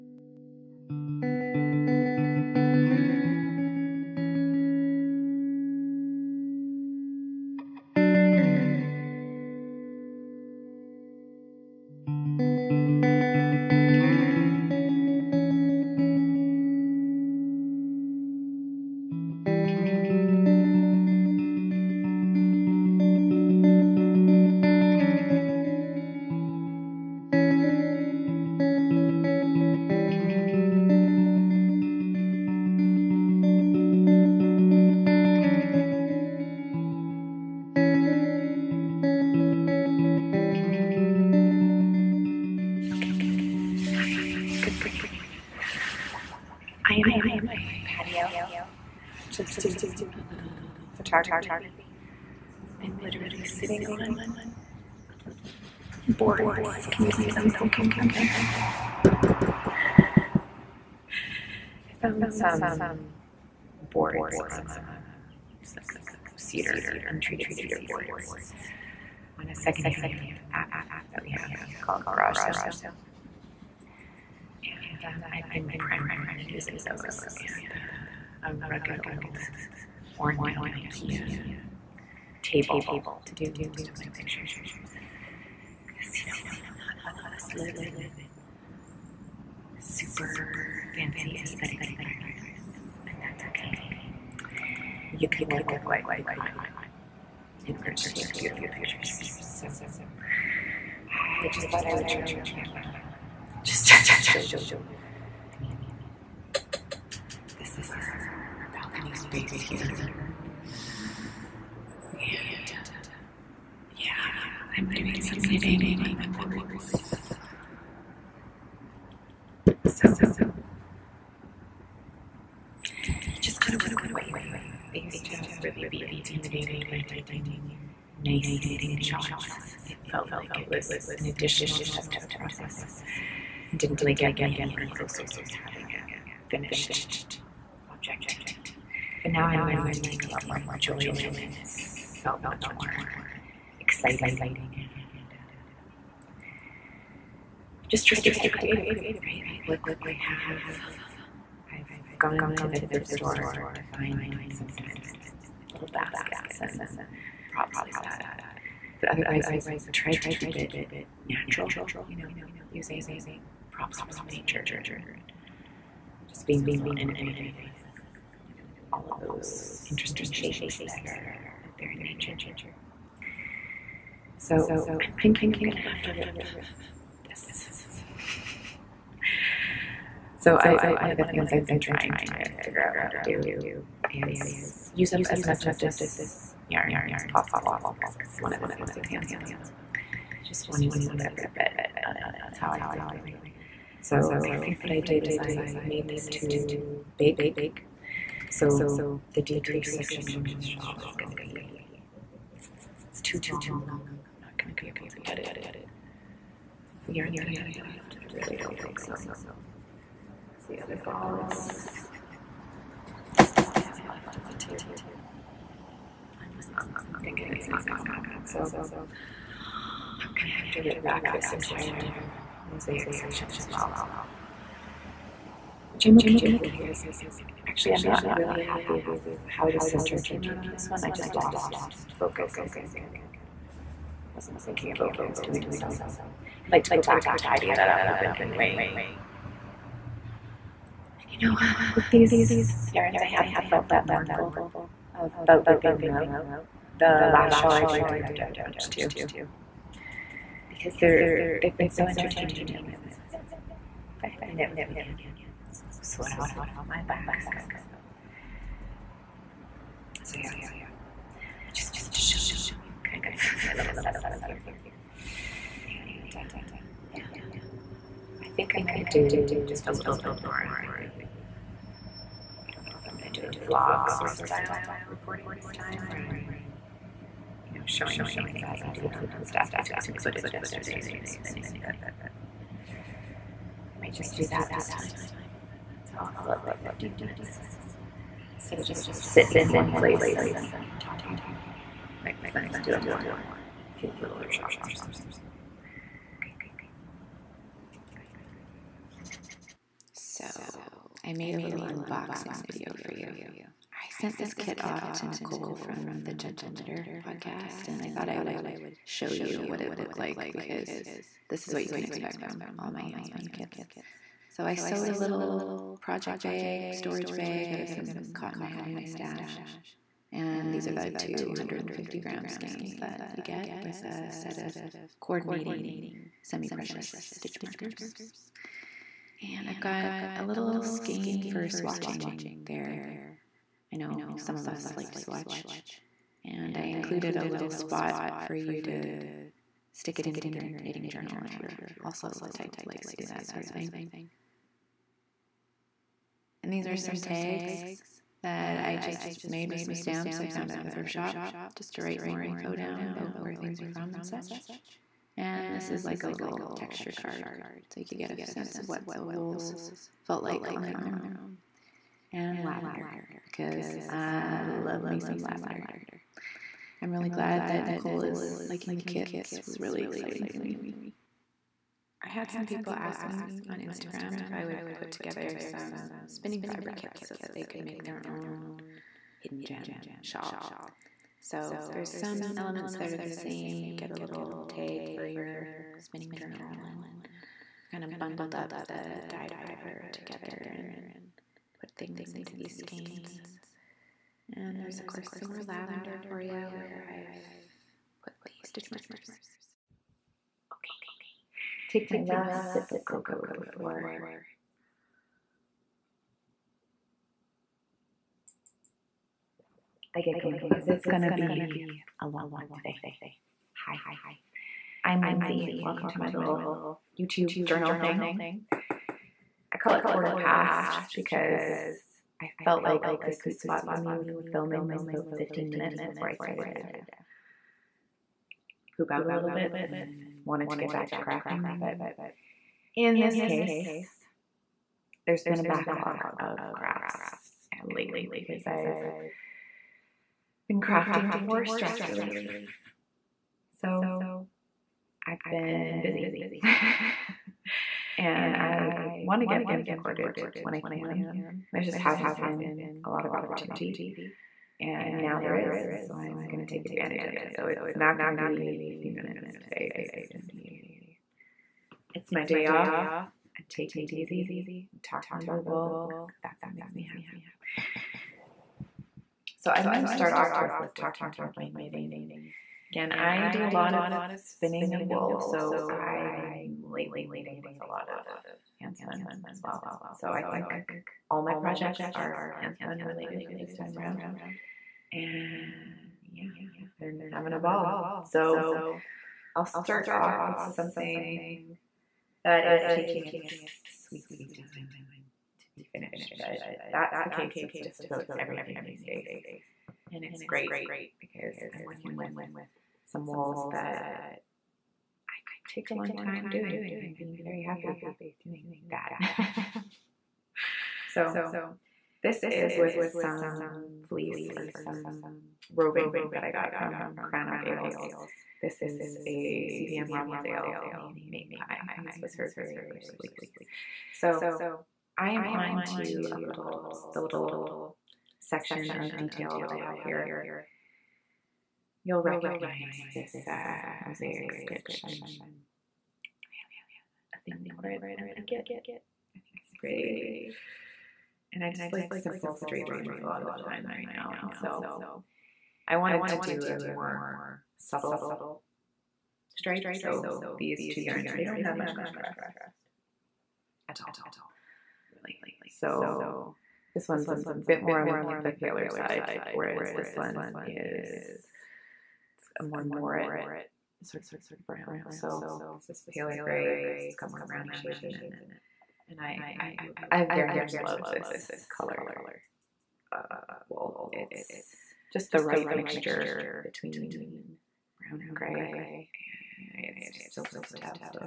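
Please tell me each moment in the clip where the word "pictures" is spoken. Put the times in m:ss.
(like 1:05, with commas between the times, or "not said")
1:24, 1:38.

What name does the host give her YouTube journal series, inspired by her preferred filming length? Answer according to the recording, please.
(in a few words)
Quarter Past.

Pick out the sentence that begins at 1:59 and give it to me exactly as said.
So you just gotta work with what you have.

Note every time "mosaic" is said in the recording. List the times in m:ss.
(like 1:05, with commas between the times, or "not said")
3:42, 8:54.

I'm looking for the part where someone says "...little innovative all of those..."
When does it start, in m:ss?
2:46.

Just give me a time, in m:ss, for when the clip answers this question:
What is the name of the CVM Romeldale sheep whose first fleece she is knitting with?
8:41.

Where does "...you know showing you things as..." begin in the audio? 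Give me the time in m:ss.
4:37.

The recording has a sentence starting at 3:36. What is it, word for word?
I'm just not, I'm thinking it's not going to happen.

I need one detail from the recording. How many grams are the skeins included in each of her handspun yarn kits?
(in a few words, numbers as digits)
250.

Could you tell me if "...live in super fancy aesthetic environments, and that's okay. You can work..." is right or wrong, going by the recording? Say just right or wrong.
right.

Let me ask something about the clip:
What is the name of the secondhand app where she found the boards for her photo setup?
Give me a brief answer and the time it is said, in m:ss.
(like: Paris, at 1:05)
Garage Sale, at 1:12.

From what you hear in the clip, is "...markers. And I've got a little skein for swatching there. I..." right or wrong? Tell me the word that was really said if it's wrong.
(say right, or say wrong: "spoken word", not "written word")
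right.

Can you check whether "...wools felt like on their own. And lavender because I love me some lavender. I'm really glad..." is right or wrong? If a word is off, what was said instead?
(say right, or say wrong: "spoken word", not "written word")
right.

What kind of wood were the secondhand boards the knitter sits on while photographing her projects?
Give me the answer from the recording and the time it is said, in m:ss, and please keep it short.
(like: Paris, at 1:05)
untreated cedar, at 1:07.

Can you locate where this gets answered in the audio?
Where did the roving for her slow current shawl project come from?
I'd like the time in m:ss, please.
8:37.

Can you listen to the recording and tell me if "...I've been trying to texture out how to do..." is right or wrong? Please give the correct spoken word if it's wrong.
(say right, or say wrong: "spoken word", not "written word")
wrong: "figure", not "texture".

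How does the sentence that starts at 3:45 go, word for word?
Which I'm okay with because actually, I'm not really happy with how the center came out on this one.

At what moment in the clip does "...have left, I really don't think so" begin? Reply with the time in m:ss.
3:27.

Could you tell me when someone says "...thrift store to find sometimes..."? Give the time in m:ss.
2:32.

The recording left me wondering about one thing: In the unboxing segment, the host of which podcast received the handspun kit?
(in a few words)
Gentle Knitter.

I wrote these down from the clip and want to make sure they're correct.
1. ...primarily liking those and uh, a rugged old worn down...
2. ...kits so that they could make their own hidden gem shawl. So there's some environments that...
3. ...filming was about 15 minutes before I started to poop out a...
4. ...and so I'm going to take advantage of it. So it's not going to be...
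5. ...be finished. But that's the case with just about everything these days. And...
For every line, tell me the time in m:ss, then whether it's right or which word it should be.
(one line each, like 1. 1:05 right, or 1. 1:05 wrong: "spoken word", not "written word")
1. 1:15 wrong: "using", not "liking"
2. 6:16 wrong: "elements", not "environments"
3. 7:04 right
4. 7:35 right
5. 8:15 right.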